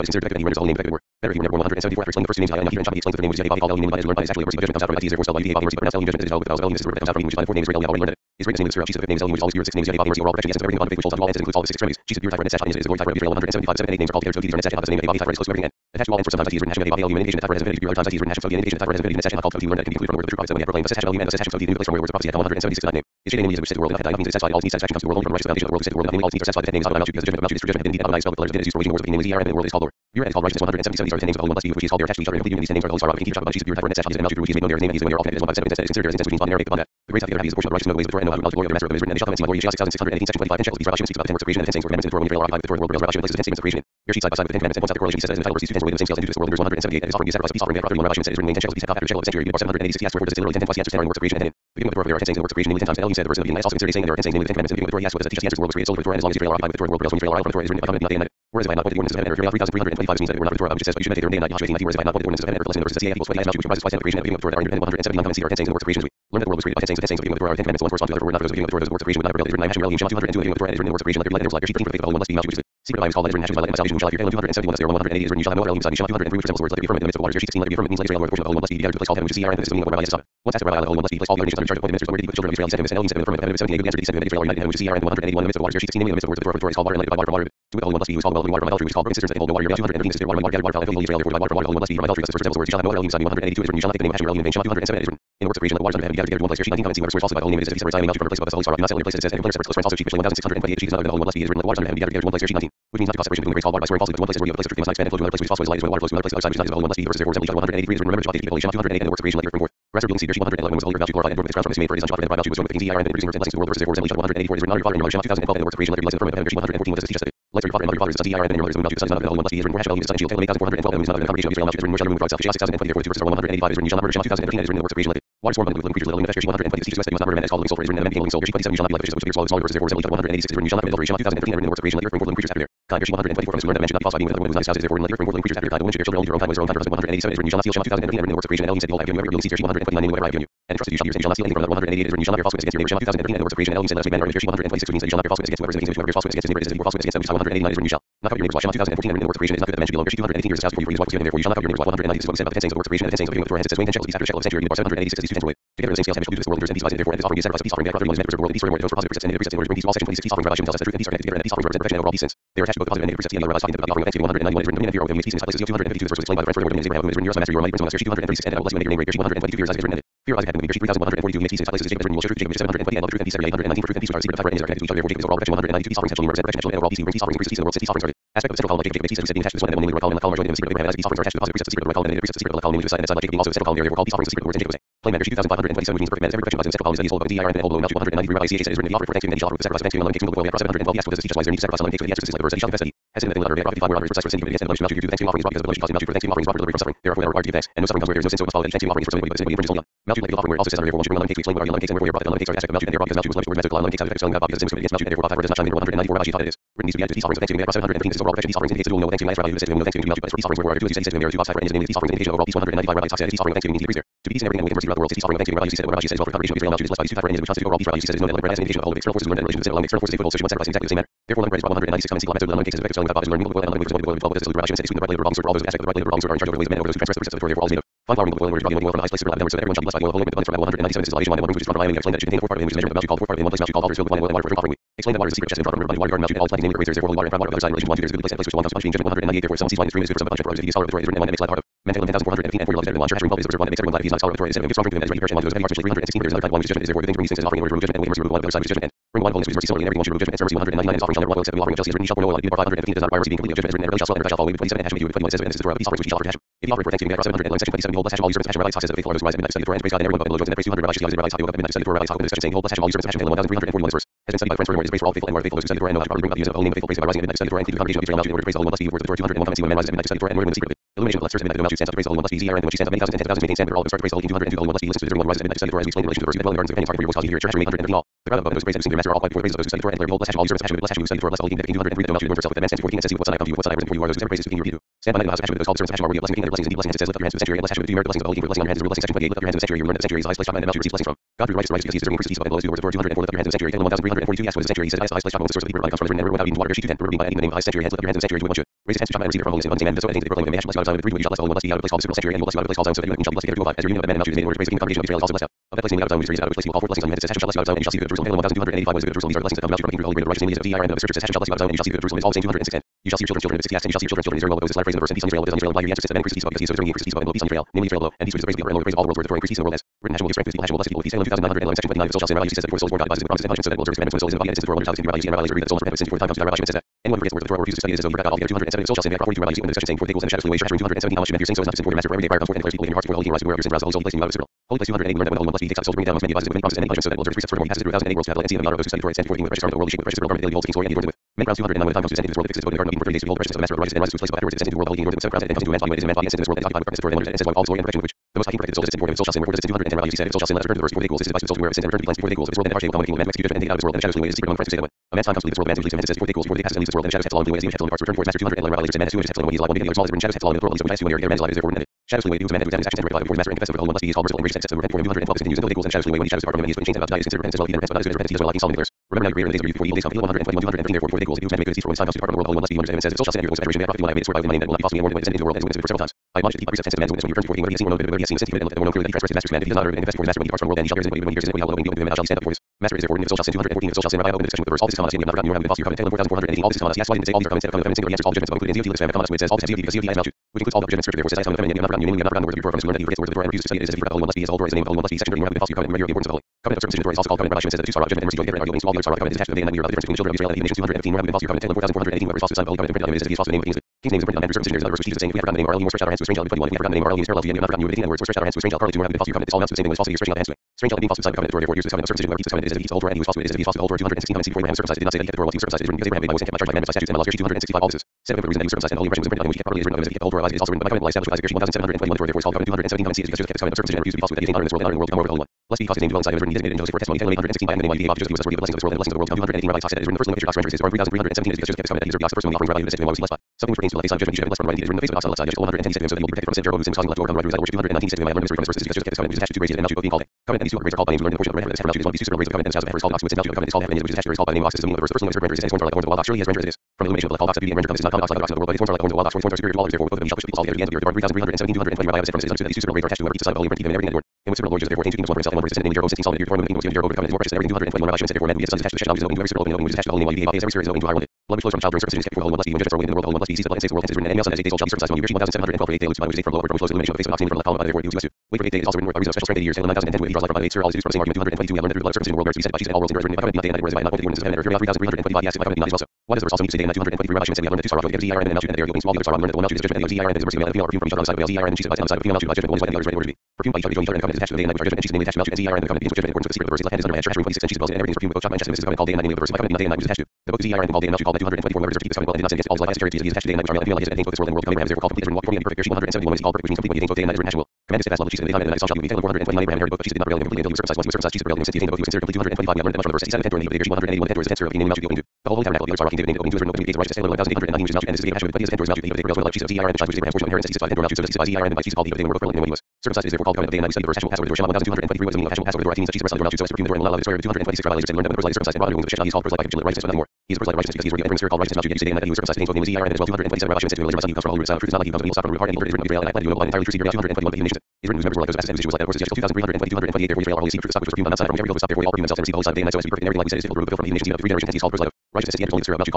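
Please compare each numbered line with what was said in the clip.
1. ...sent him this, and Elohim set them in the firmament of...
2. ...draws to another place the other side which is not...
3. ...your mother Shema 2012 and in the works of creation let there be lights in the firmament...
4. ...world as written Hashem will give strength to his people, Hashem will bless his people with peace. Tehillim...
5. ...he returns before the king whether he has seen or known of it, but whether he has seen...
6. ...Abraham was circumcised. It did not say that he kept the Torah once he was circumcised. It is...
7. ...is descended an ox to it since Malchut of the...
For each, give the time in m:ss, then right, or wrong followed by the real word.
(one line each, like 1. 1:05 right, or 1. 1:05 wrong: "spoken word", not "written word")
1. 1:22 right
2. 1:45 wrong: "flows", not "draws"
3. 1:54 right
4. 5:19 right
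5. 6:17 right
6. 6:54 right
7. 7:22 wrong: "called", not "descended".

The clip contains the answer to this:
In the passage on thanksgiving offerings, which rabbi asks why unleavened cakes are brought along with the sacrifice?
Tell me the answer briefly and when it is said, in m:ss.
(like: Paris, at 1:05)
Rabbi Acha, at 3:08.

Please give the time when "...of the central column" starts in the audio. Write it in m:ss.
2:58.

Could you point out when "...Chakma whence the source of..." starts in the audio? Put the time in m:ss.
4:55.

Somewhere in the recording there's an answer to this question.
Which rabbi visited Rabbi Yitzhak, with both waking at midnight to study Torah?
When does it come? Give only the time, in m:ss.
4:20.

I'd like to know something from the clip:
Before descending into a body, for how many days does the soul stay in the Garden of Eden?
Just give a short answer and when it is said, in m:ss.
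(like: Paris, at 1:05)
30, at 5:43.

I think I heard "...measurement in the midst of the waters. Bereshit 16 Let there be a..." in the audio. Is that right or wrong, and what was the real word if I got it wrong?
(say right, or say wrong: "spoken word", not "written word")
wrong: "firmament", not "measurement".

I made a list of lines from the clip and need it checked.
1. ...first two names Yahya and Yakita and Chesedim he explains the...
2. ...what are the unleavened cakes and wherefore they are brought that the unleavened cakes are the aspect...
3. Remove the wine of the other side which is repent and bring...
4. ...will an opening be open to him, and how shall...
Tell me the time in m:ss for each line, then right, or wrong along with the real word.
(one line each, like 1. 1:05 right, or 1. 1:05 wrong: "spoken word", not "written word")
1. 0:02 wrong: "Chakma", not "Chesedim"
2. 3:21 right
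3. 4:08 wrong: "judgment", not "repent"
4. 6:21 right.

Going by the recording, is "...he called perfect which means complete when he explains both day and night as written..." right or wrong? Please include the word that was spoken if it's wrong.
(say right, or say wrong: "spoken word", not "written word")
wrong: "attains", not "explains".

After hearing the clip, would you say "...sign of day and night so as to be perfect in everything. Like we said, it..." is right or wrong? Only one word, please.
right.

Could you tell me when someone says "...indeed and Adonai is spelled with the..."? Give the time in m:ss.
0:27.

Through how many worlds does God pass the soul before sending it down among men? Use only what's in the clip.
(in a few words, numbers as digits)
1008.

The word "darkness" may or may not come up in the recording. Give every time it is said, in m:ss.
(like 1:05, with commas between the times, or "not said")
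5:46.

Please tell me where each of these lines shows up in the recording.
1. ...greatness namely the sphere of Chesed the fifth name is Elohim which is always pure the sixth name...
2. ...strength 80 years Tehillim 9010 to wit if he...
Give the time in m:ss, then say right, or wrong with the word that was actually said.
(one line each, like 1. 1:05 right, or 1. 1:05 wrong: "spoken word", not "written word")
1. 0:08 right
2. 7:49 right.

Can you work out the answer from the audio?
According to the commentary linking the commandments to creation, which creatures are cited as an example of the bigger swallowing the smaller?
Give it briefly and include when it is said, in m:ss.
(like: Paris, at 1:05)
fishes, at 2:09.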